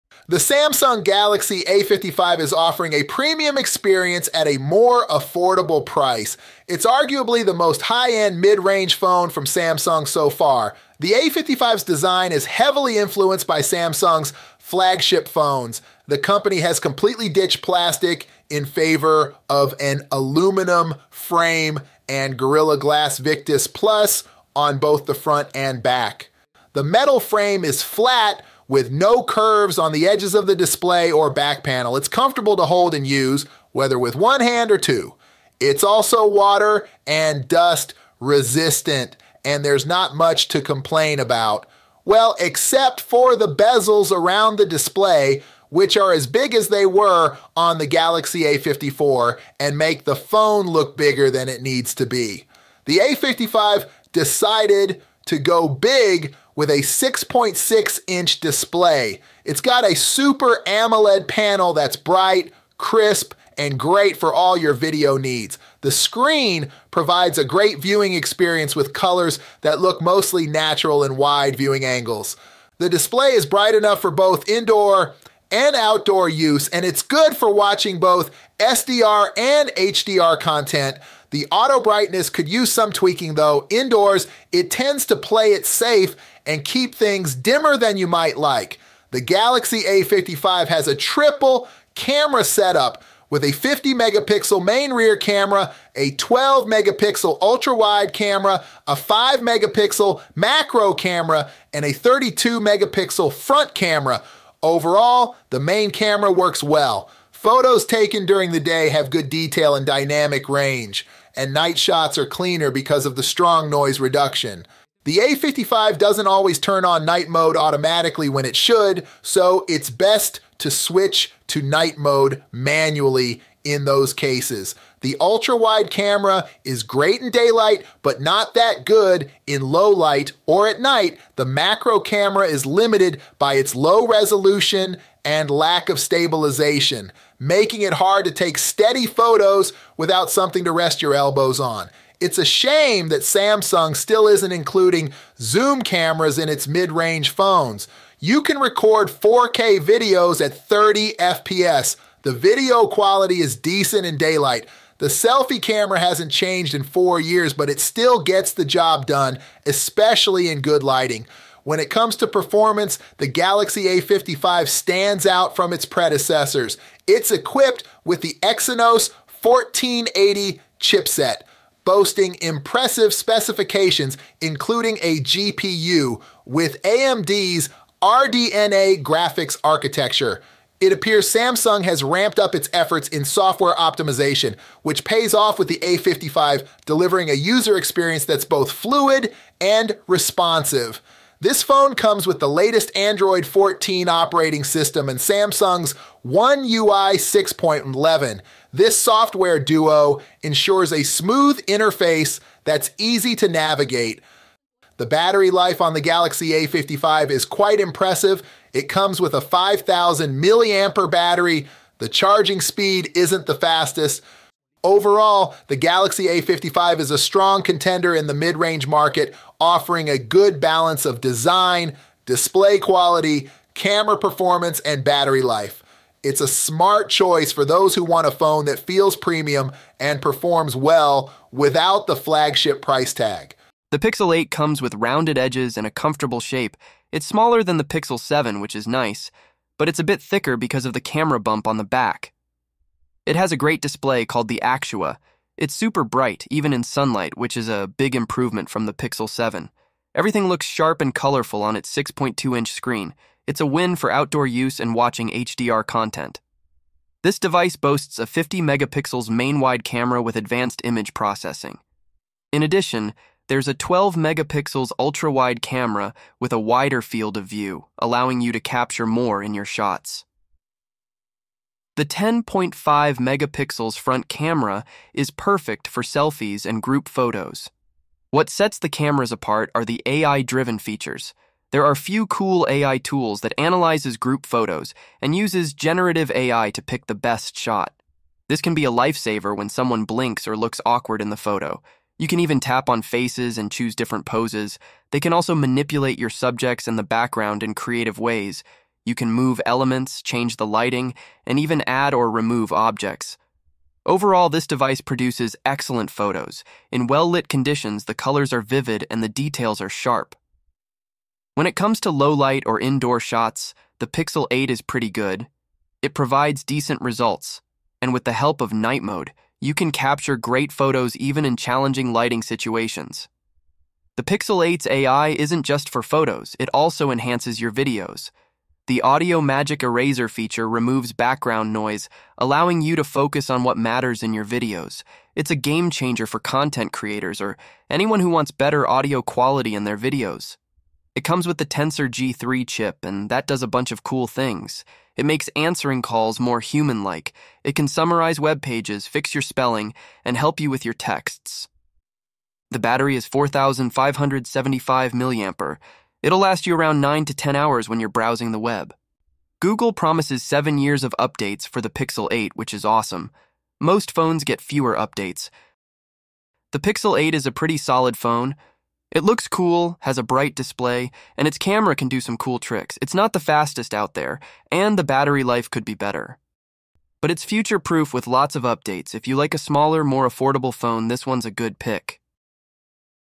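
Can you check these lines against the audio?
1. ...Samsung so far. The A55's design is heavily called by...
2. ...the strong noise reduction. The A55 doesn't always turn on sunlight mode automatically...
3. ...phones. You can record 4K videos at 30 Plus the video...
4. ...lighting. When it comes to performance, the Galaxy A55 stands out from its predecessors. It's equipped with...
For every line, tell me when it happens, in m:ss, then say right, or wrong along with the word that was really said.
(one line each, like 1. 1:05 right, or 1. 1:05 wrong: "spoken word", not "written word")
1. 0:09 wrong: "influenced", not "called"
2. 1:53 wrong: "night", not "sunlight"
3. 2:27 wrong: "FPS", not "Plus"
4. 2:40 right.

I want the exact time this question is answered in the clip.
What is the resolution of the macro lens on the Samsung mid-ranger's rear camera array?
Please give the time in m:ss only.
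1:38.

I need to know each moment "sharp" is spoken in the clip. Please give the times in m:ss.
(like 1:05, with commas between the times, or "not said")
4:10, 5:09.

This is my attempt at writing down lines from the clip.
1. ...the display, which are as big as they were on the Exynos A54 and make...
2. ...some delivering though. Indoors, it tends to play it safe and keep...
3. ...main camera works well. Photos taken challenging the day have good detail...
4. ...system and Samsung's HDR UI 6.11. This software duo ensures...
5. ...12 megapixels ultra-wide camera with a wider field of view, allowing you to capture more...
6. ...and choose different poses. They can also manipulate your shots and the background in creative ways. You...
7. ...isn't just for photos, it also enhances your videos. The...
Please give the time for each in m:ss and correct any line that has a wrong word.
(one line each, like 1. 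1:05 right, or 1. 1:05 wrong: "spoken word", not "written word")
1. 0:44 wrong: "Galaxy", not "Exynos"
2. 1:22 wrong: "tweaking", not "delivering"
3. 1:45 wrong: "during", not "challenging"
4. 3:14 wrong: "One", not "HDR"
5. 4:23 right
6. 4:53 wrong: "subjects", not "shots"
7. 5:25 right.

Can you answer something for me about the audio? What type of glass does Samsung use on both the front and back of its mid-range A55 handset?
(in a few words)
Gorilla Glass Victus Plus.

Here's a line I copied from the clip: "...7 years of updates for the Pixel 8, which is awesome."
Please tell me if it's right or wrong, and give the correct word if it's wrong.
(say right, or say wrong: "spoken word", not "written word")
right.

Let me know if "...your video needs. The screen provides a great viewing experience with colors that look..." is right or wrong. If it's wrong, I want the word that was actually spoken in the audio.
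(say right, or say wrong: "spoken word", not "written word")
right.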